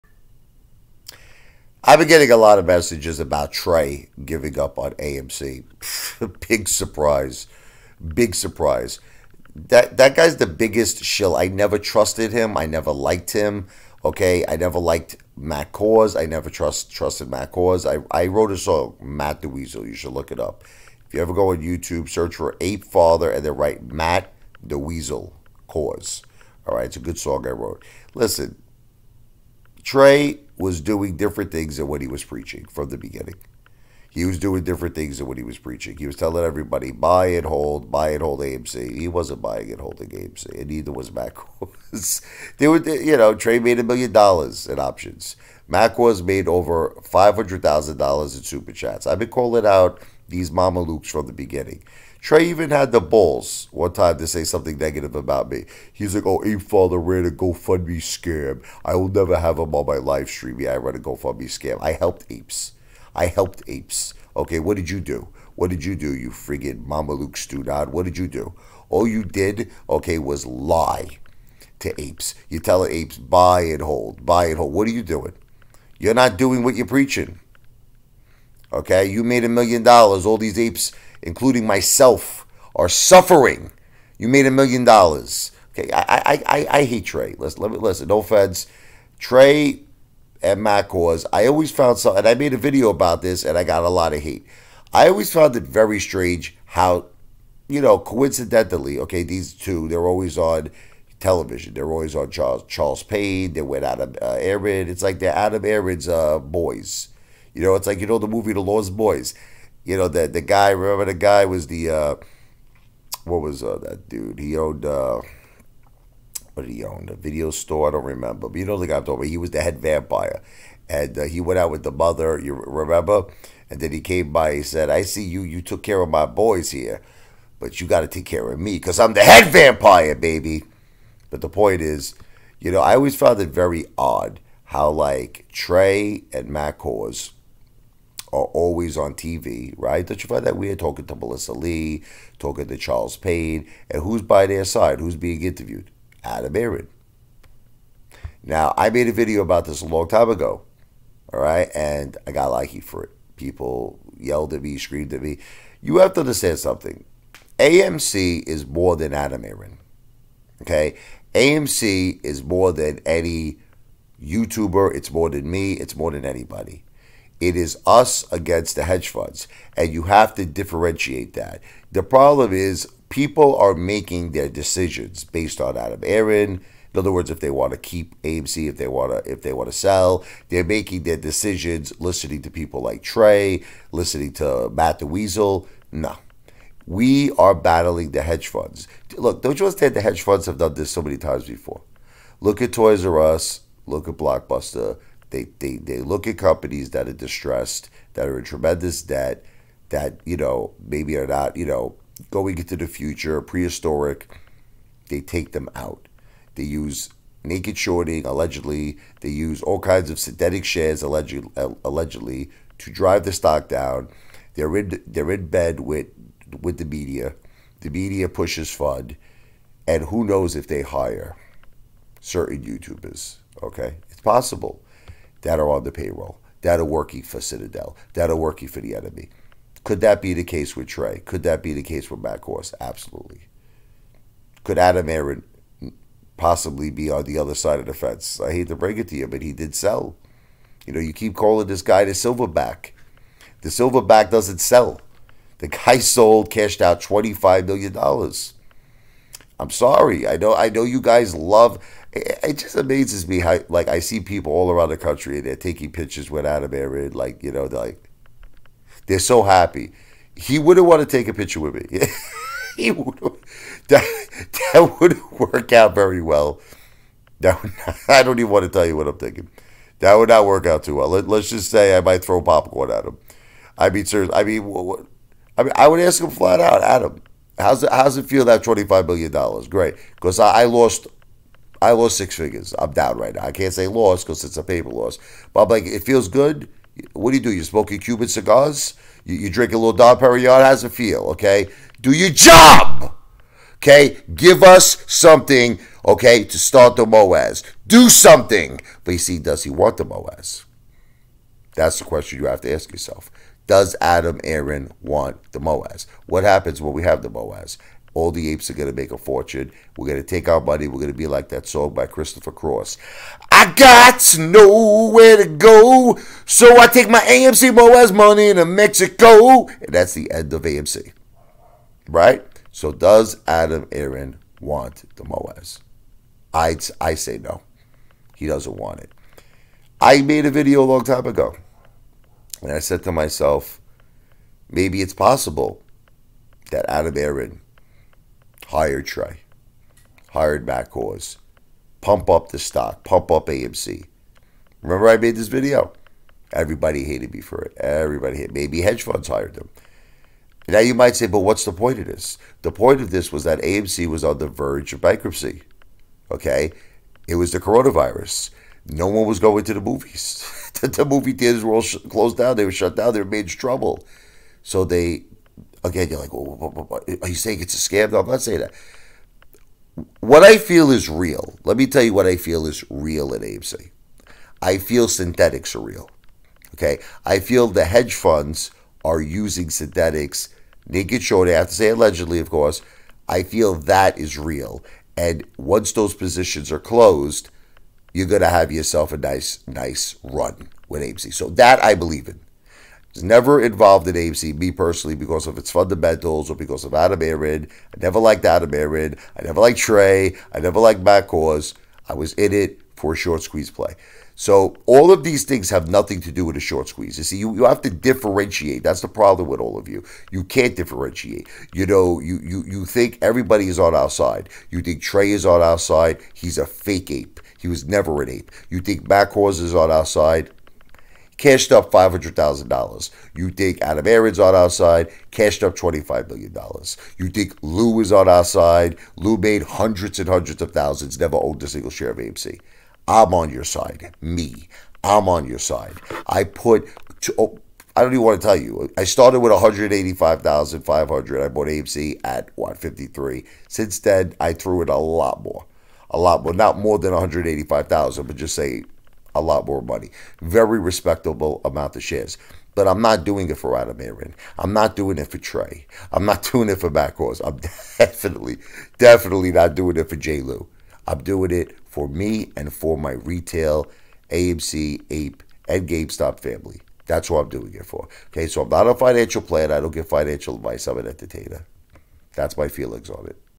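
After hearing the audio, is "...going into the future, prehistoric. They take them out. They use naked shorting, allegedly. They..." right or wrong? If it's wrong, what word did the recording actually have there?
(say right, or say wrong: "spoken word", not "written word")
right.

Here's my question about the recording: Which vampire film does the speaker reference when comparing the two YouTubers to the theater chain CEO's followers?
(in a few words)
The Lost Boys.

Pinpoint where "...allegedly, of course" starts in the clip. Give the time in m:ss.
6:21.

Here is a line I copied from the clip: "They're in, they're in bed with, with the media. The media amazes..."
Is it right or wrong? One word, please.
wrong.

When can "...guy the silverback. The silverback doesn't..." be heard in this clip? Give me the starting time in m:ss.
4:01.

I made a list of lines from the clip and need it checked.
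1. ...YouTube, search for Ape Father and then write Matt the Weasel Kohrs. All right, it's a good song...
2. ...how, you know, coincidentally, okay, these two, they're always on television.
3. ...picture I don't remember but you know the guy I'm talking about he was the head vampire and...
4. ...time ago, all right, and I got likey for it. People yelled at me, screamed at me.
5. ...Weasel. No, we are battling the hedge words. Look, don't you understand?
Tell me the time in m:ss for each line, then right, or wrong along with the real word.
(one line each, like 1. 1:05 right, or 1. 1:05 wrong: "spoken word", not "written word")
1. 0:21 right
2. 1:36 right
3. 1:57 wrong: "store", not "picture"
4. 2:30 right
5. 3:05 wrong: "funds", not "words".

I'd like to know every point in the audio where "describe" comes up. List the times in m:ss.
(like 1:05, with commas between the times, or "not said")
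not said.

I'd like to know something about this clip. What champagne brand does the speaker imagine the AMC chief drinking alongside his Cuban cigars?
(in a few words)
Dom Perignon.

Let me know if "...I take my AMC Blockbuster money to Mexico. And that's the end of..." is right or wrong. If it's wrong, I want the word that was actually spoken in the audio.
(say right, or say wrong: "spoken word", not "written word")
wrong: "MOASS", not "Blockbuster".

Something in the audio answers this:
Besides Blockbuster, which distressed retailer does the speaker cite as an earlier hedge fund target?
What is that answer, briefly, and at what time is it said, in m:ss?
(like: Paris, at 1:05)
Toys R Us, at 3:12.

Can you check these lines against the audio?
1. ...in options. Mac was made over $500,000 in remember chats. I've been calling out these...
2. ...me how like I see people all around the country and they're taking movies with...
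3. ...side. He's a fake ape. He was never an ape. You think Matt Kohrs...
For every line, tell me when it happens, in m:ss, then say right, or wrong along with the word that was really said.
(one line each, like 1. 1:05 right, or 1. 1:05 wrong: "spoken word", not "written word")
1. 0:44 wrong: "super", not "remember"
2. 4:13 wrong: "pictures", not "movies"
3. 6:55 right.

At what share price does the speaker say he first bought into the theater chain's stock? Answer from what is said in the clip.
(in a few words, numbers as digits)
53.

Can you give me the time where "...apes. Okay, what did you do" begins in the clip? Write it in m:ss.
1:03.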